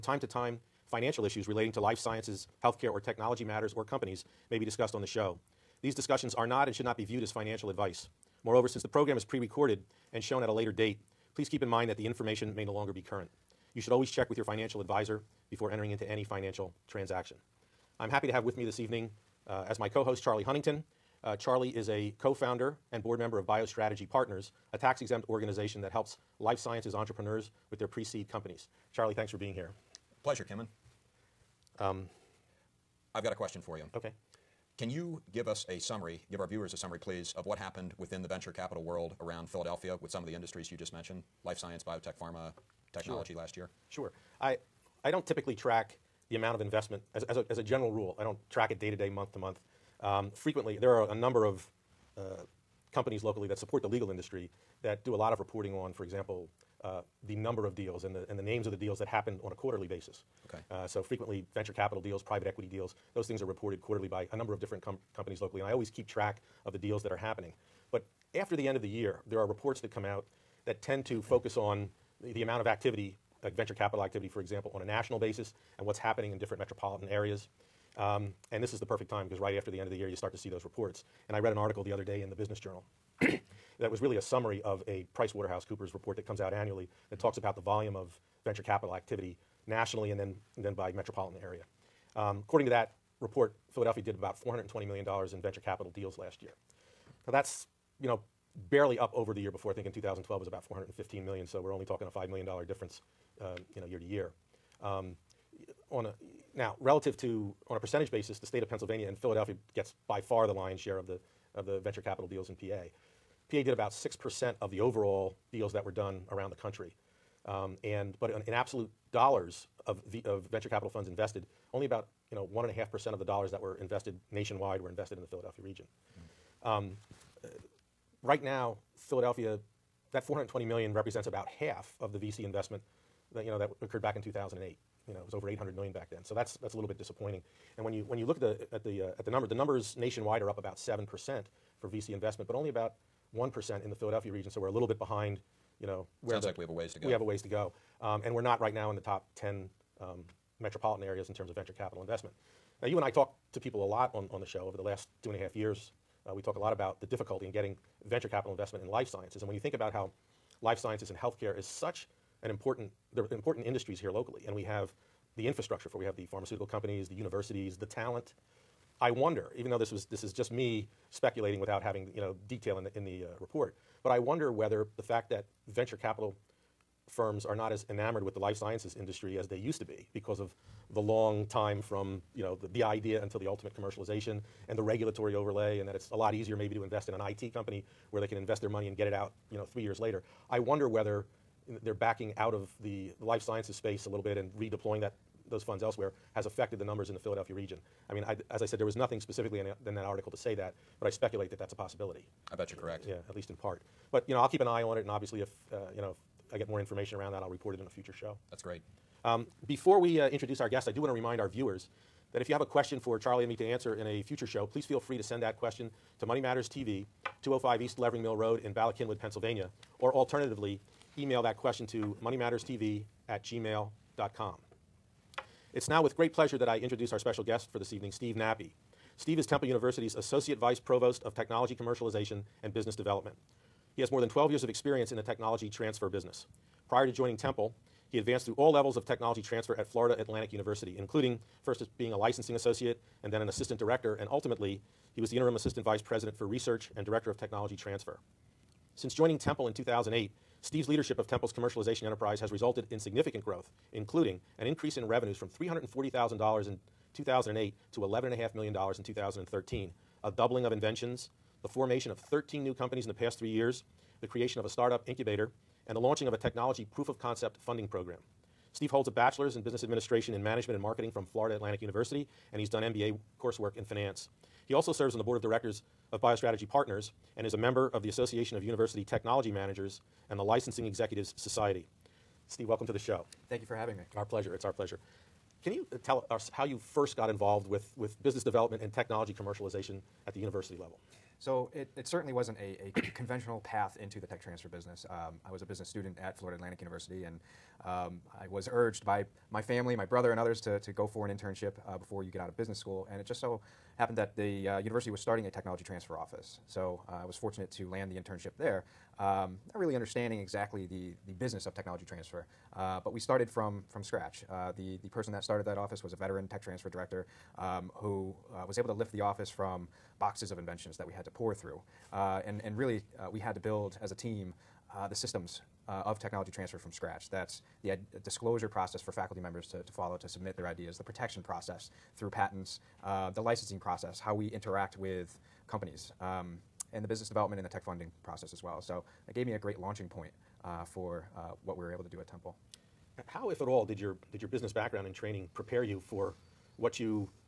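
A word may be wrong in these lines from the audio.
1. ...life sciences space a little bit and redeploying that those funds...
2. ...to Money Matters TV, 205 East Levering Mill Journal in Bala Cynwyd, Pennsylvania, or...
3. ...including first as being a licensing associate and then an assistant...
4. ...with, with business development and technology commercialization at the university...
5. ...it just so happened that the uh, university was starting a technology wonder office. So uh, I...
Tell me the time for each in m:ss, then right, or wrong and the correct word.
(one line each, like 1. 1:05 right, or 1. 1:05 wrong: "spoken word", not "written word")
1. 3:13 right
2. 3:36 wrong: "Road", not "Journal"
3. 4:00 right
4. 4:47 right
5. 5:03 wrong: "transfer", not "wonder".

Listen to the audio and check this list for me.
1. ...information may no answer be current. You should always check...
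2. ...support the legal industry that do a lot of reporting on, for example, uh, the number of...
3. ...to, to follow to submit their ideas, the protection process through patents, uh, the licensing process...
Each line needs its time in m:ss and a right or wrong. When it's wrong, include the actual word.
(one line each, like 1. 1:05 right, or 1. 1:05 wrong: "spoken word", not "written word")
1. 0:12 wrong: "longer", not "answer"
2. 0:53 right
3. 5:29 right.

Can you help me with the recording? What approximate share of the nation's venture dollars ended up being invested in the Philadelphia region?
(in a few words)
1.5%.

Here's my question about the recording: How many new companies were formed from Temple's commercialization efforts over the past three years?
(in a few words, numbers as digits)
13.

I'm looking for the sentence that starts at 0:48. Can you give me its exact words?
I don't track it day to day, month to month.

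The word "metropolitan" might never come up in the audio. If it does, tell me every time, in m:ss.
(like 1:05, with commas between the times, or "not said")
1:16, 1:30, 2:30.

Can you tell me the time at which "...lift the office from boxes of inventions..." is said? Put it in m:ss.
5:18.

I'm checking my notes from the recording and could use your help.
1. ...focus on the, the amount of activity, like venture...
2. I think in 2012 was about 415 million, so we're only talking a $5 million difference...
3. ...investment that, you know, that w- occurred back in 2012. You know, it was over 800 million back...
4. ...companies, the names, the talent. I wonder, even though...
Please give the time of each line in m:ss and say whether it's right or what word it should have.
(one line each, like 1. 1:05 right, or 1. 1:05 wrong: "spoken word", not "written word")
1. 1:11 right
2. 1:39 right
3. 2:12 wrong: "2008", not "2012"
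4. 2:46 wrong: "universities", not "names".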